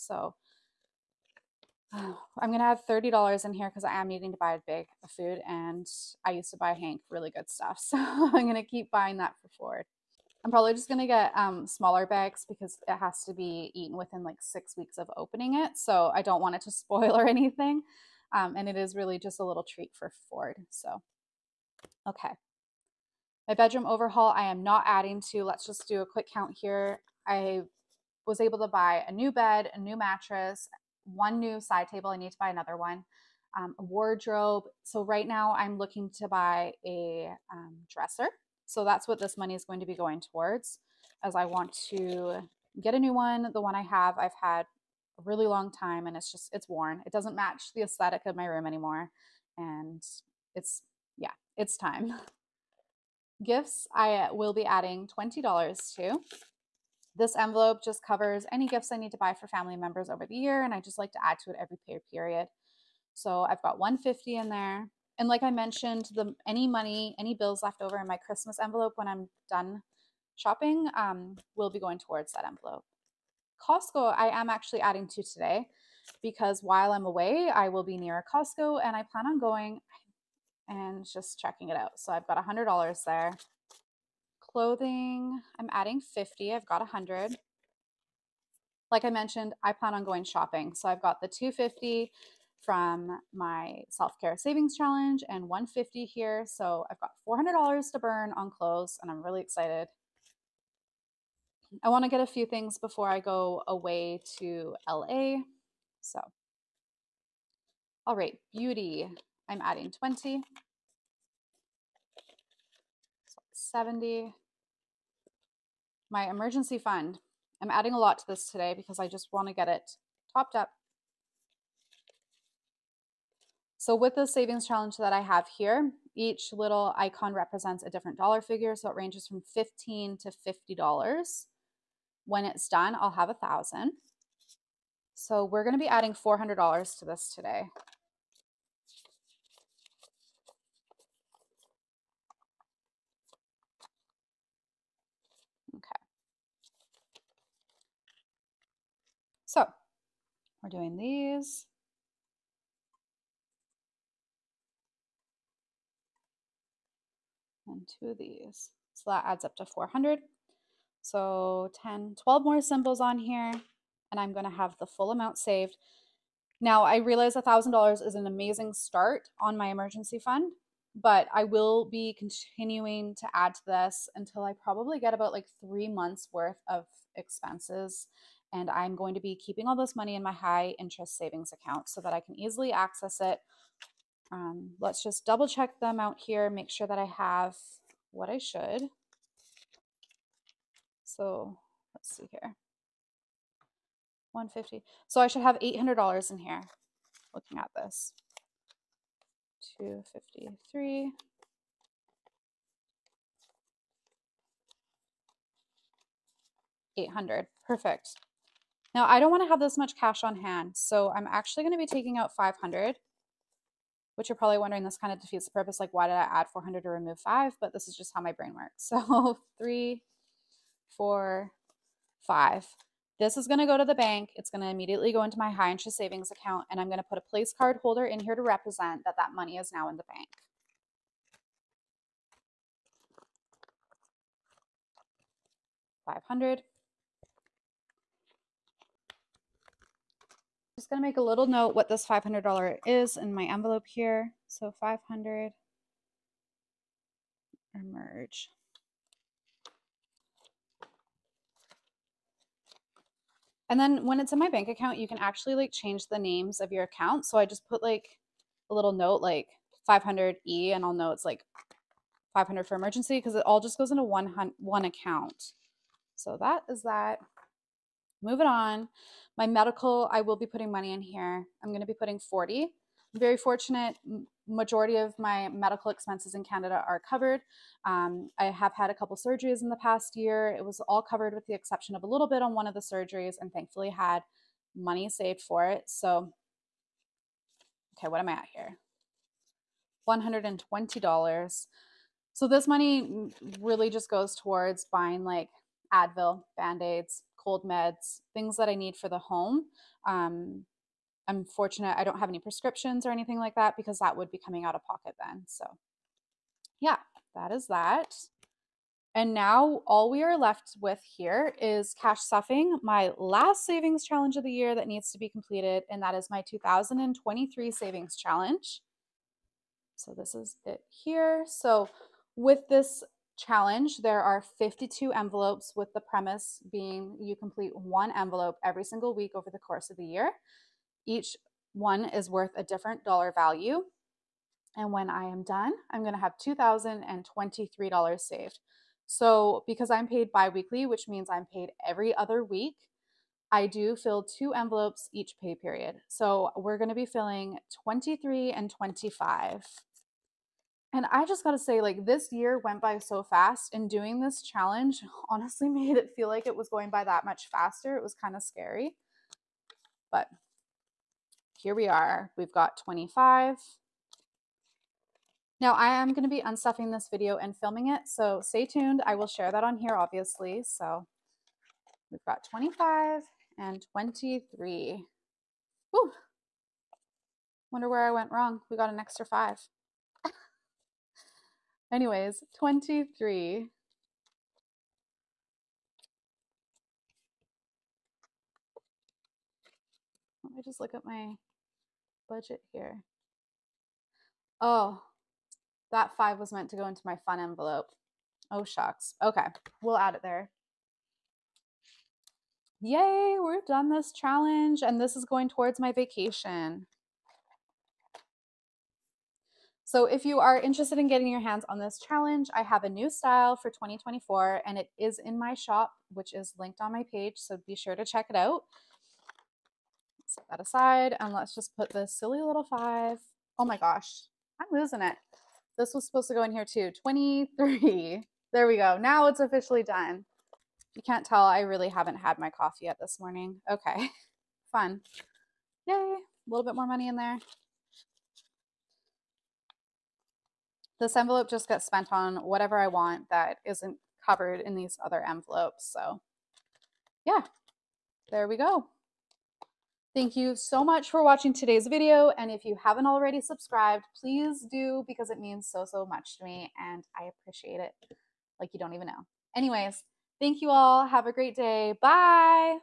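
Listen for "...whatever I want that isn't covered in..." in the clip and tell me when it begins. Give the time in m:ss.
7:22.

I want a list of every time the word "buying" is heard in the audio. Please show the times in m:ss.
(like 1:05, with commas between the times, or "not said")
0:08, 4:54.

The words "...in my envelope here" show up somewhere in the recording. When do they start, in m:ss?
4:03.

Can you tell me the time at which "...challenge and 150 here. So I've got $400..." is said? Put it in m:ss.
1:34.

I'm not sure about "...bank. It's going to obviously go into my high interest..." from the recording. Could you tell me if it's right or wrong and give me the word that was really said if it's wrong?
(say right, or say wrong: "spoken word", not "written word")
wrong: "immediately", not "obviously".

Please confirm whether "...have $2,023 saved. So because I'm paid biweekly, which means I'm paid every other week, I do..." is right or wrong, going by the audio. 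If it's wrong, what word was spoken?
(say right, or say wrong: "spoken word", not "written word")
right.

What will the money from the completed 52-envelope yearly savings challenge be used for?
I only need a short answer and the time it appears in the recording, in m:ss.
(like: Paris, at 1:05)
vacation, at 6:45.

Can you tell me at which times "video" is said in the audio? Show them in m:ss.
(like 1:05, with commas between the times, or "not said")
6:07, 7:31.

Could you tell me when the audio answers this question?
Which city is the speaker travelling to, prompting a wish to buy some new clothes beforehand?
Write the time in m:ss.
1:44.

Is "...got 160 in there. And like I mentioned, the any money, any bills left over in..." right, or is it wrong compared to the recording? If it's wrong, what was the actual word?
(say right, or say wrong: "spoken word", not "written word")
wrong: "150", not "160".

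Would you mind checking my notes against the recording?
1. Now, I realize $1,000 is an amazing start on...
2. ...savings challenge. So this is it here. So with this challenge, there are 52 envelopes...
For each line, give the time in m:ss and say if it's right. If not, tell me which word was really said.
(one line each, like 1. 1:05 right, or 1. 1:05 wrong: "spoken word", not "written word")
1. 2:46 right
2. 5:17 right.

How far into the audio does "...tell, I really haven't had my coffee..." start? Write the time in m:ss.
7:11.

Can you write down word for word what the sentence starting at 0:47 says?
It doesn't match the aesthetic of my room anymore.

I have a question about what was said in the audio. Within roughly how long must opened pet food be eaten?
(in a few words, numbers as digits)
six weeks.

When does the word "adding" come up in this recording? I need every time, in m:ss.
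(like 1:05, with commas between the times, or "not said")
0:24, 0:54, 1:14, 1:25, 1:49, 1:57, 2:15.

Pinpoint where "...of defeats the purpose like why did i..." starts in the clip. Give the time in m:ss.
3:35.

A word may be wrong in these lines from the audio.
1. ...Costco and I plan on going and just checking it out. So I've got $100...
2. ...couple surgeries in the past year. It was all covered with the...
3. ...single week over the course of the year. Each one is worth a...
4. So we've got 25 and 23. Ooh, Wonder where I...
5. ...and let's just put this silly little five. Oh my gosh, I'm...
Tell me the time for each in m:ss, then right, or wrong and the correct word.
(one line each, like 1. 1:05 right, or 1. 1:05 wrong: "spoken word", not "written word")
1. 1:18 right
2. 4:38 right
3. 5:28 right
4. 6:10 right
5. 7:01 right.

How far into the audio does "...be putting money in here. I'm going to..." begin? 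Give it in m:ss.
4:30.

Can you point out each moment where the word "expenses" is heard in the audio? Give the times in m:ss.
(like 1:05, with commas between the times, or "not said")
2:57, 4:35.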